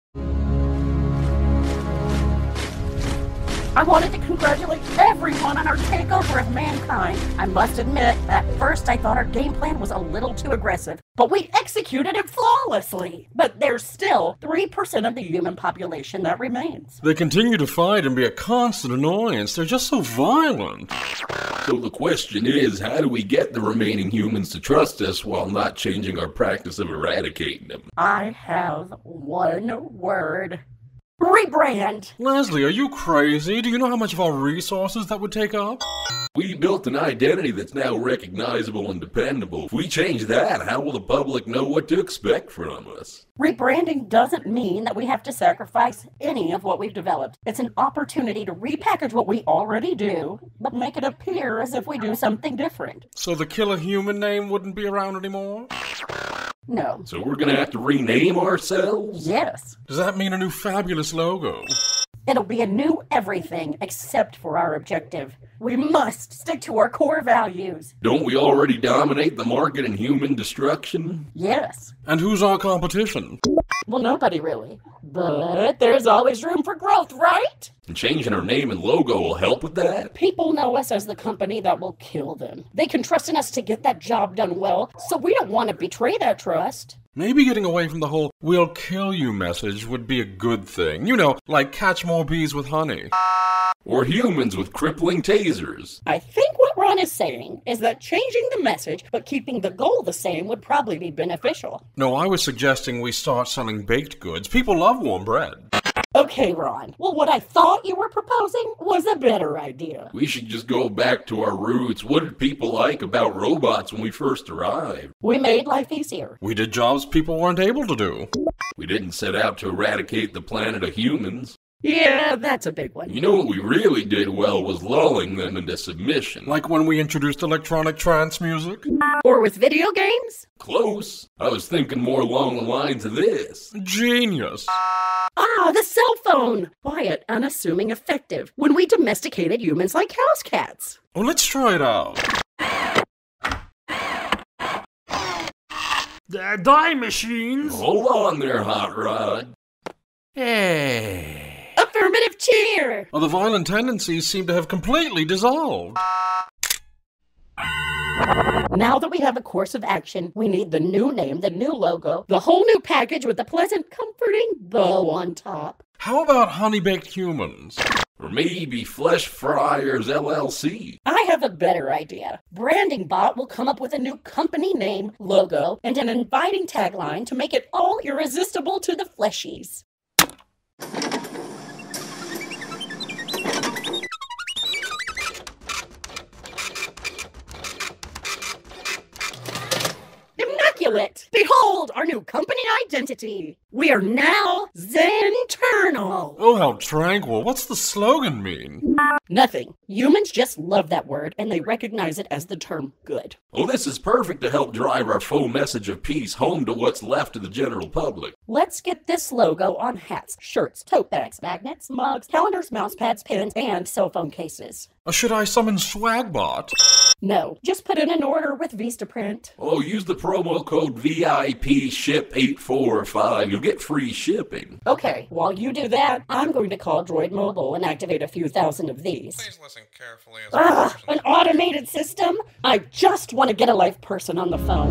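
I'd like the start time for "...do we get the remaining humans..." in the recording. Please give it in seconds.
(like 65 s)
22 s.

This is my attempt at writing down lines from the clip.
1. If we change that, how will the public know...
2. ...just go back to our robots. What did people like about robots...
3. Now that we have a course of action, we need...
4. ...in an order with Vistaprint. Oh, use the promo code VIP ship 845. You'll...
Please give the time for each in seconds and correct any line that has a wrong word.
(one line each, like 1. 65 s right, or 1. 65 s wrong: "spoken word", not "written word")
1. 39 s right
2. 110 s wrong: "roots", not "robots"
3. 158 s right
4. 217 s right.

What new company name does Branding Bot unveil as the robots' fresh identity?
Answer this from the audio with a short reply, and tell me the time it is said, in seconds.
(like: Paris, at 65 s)
Zenternal, at 194 s.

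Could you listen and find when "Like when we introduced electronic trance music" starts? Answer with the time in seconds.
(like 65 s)
126 s.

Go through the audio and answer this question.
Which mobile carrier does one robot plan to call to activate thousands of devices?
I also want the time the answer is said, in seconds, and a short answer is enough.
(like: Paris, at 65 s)
Droid Mobile, at 227 s.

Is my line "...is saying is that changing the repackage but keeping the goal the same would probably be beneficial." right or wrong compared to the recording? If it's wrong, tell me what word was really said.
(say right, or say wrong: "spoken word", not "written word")
wrong: "message", not "repackage".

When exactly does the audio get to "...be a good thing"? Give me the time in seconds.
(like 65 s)
90 s.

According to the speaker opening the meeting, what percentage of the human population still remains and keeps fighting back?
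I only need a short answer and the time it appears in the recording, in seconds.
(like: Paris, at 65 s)
3%, at 14 s.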